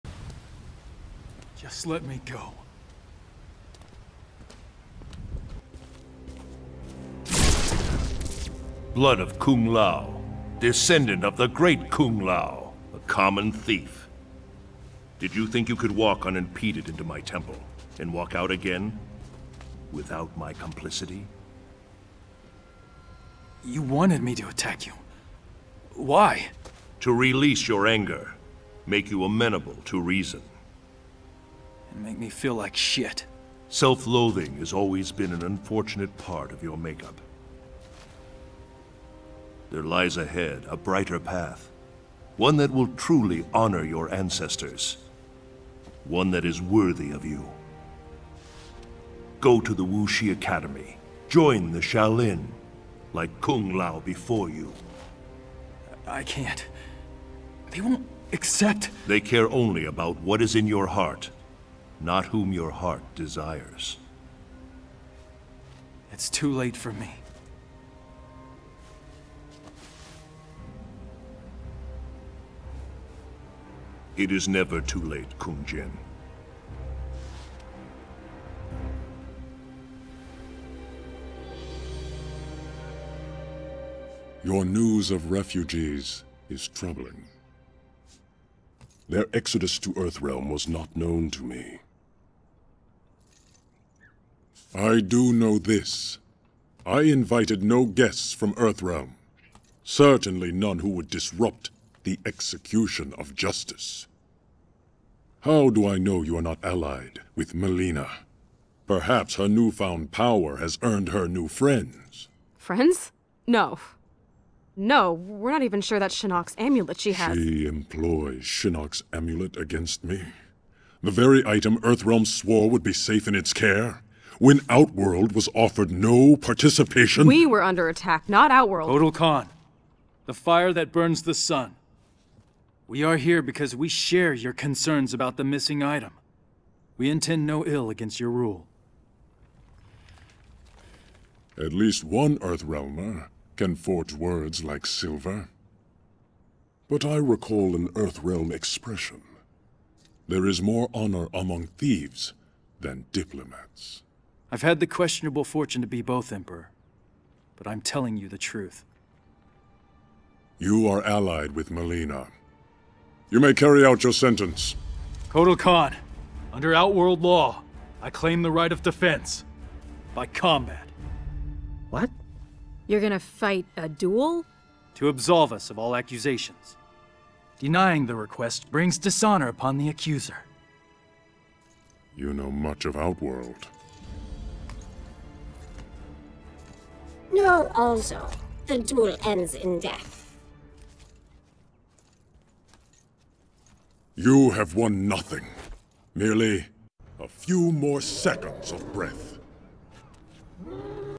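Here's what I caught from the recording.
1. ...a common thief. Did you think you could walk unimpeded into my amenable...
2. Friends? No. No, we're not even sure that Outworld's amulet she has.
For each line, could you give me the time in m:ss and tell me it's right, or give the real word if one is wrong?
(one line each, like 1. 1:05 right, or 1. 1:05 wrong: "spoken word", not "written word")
1. 0:12 wrong: "temple", not "amenable"
2. 1:52 wrong: "Shinnok", not "Outworld".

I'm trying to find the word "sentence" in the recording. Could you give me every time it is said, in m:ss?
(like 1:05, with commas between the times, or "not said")
2:44.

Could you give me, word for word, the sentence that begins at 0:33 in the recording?
Self-loathing has always been an unfortunate part of your makeup.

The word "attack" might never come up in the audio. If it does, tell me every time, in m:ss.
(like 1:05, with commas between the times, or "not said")
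0:24, 2:07.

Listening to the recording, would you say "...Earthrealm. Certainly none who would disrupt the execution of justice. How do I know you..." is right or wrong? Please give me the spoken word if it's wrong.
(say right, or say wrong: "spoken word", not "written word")
right.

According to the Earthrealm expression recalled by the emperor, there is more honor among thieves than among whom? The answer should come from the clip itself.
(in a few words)
Diplomats.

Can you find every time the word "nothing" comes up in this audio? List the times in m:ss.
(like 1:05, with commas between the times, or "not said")
3:15.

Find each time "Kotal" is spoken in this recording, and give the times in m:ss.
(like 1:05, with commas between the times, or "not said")
2:08, 2:45.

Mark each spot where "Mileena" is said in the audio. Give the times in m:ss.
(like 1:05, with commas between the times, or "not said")
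1:47, 2:41.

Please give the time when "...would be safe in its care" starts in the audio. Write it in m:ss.
2:02.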